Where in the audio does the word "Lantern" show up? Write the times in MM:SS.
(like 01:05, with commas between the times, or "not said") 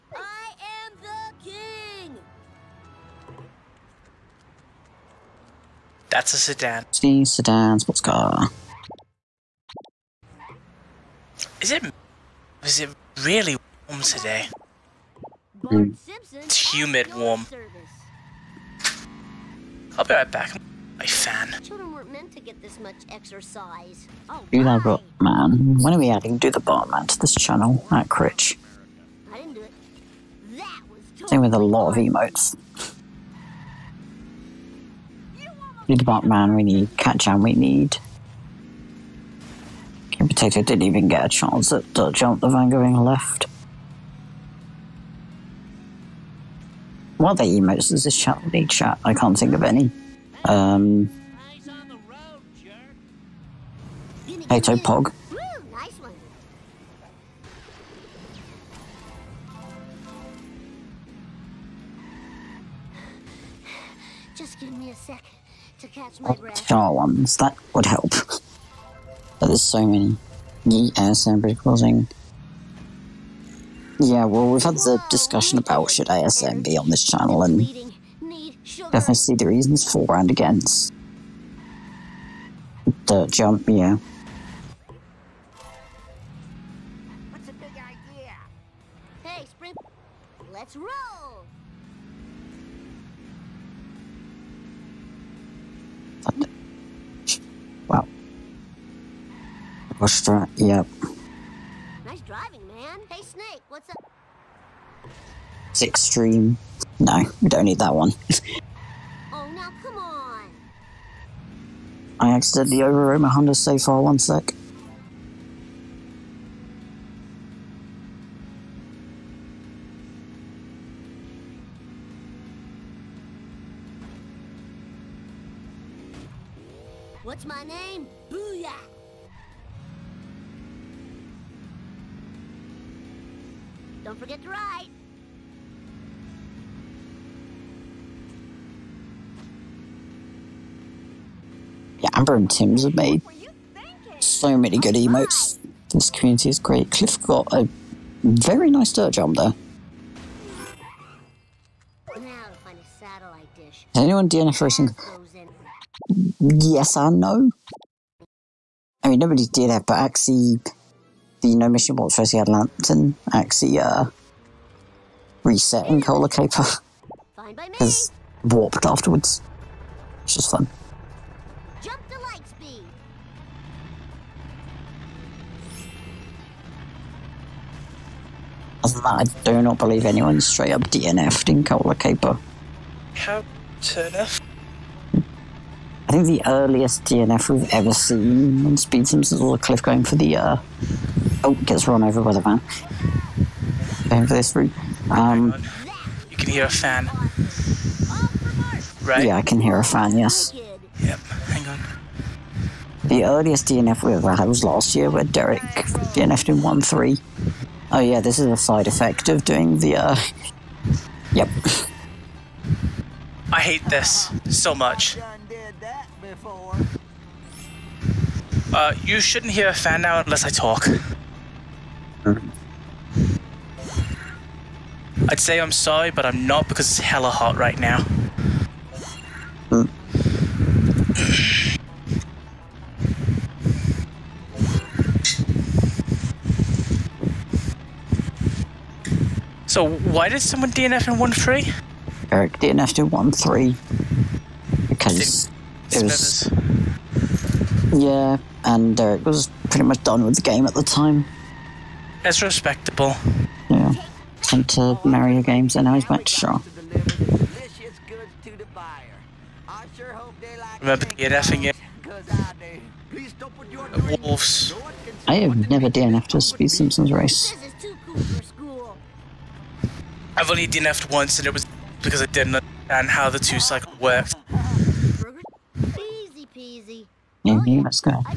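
02:42.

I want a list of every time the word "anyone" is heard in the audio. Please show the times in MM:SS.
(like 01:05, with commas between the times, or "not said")
02:34, 03:00.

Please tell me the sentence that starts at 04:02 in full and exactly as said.
Eric DNF'd in one three because it was yeah, and Eric was pretty much done with the game at the time.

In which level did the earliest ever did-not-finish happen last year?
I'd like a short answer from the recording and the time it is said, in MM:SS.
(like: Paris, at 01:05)
1-3, at 03:26.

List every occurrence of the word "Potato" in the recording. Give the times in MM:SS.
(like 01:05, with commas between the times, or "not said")
00:40.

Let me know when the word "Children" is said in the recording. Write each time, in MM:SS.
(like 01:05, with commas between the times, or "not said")
00:21.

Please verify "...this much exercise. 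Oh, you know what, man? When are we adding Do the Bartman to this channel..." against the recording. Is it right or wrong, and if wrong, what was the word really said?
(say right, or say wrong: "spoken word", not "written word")
right.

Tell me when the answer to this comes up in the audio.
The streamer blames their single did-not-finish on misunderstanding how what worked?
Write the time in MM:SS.
04:33.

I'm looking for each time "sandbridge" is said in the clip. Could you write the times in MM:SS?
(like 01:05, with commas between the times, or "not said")
01:11.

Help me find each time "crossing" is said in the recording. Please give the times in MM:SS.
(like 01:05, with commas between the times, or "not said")
01:11.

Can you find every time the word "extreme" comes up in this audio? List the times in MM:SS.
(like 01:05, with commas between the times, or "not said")
01:45.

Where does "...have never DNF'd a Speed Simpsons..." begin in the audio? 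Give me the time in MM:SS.
04:25.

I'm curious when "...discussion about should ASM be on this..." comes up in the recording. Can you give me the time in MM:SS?
01:15.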